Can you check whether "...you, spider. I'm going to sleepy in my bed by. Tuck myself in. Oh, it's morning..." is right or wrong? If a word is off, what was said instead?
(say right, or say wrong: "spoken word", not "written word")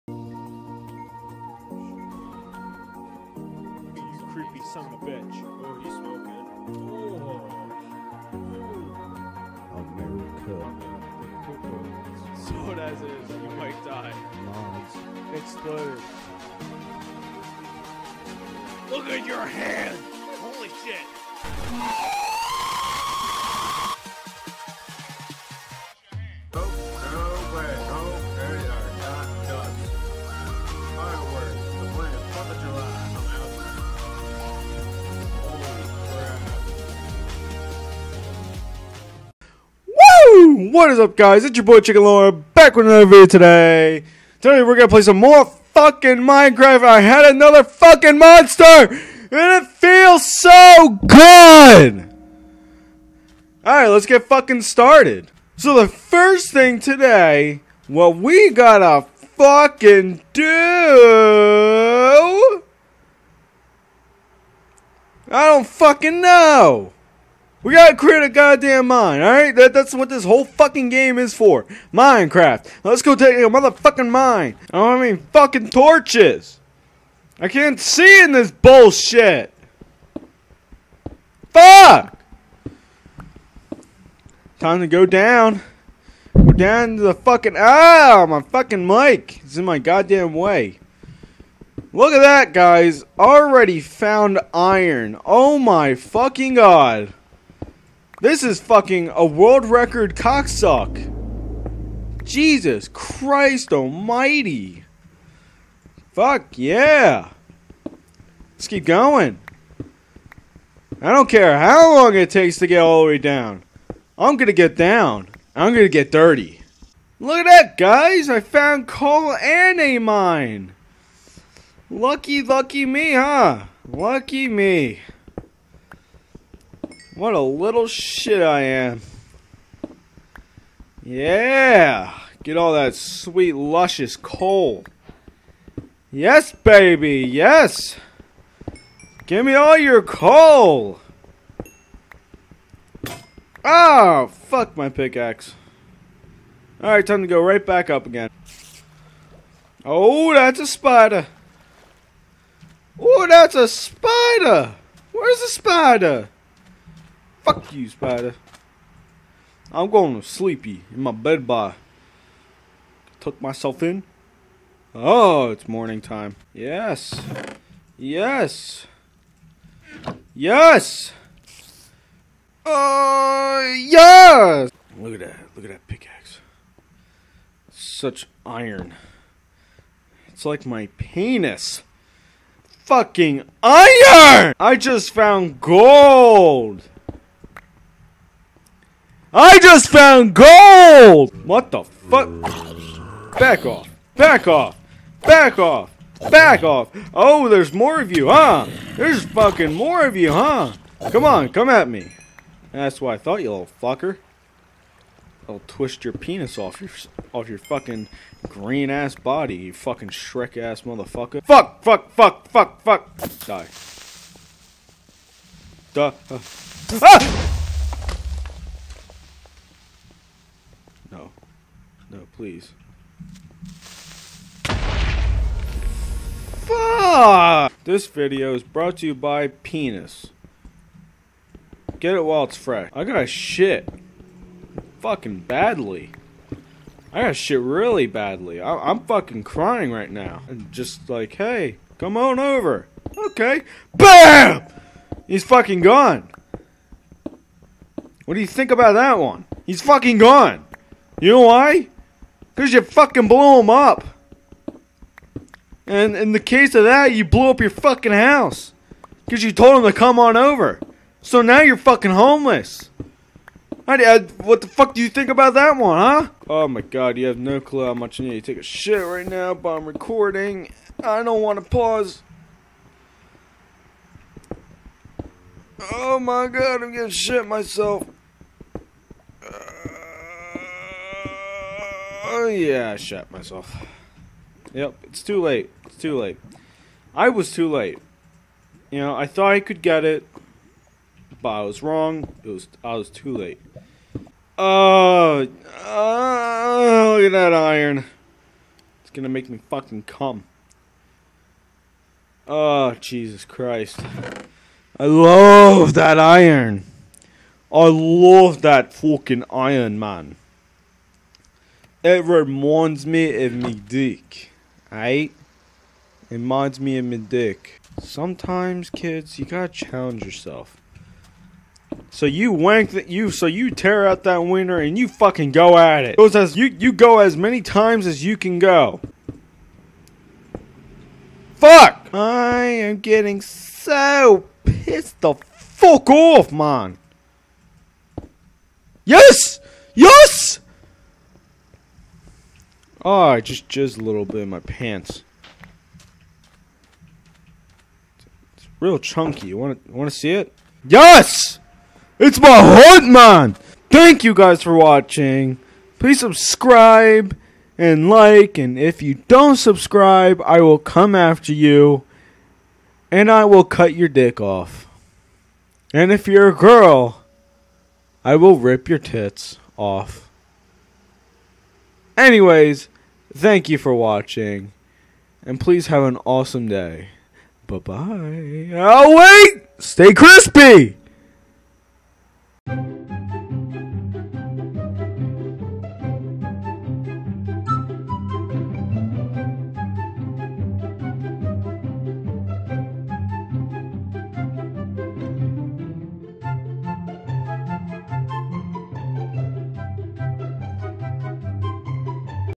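right.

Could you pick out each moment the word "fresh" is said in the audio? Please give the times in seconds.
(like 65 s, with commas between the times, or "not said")
232 s.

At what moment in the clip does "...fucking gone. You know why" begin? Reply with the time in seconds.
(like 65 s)
249 s.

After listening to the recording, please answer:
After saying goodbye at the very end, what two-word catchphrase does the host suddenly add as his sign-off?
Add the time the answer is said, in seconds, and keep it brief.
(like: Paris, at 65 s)
Stay crispy, at 379 s.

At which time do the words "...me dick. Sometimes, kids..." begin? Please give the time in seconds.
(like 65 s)
317 s.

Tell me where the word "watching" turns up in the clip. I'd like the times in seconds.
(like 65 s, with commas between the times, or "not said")
354 s, 373 s.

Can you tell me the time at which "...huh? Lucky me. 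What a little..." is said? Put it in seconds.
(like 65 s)
123 s.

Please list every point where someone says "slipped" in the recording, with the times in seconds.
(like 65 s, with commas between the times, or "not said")
not said.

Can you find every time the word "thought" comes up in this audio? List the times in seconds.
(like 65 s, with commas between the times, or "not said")
203 s, 289 s.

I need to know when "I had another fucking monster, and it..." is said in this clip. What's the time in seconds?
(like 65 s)
46 s.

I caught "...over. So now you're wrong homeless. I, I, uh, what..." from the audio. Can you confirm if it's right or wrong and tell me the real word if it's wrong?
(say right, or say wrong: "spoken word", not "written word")
wrong: "fucking", not "wrong".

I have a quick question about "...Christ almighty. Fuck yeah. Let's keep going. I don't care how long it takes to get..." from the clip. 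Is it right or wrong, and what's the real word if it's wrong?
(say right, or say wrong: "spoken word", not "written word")
right.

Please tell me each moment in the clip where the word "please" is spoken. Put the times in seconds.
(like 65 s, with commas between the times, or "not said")
222 s, 355 s, 375 s.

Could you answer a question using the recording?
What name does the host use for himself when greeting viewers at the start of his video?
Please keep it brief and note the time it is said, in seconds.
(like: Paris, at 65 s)
Chicken Lord, at 41 s.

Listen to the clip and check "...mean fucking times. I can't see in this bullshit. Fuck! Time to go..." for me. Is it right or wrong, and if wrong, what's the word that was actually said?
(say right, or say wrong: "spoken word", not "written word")
wrong: "torches", not "times".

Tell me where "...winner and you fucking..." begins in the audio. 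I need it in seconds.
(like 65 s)
324 s.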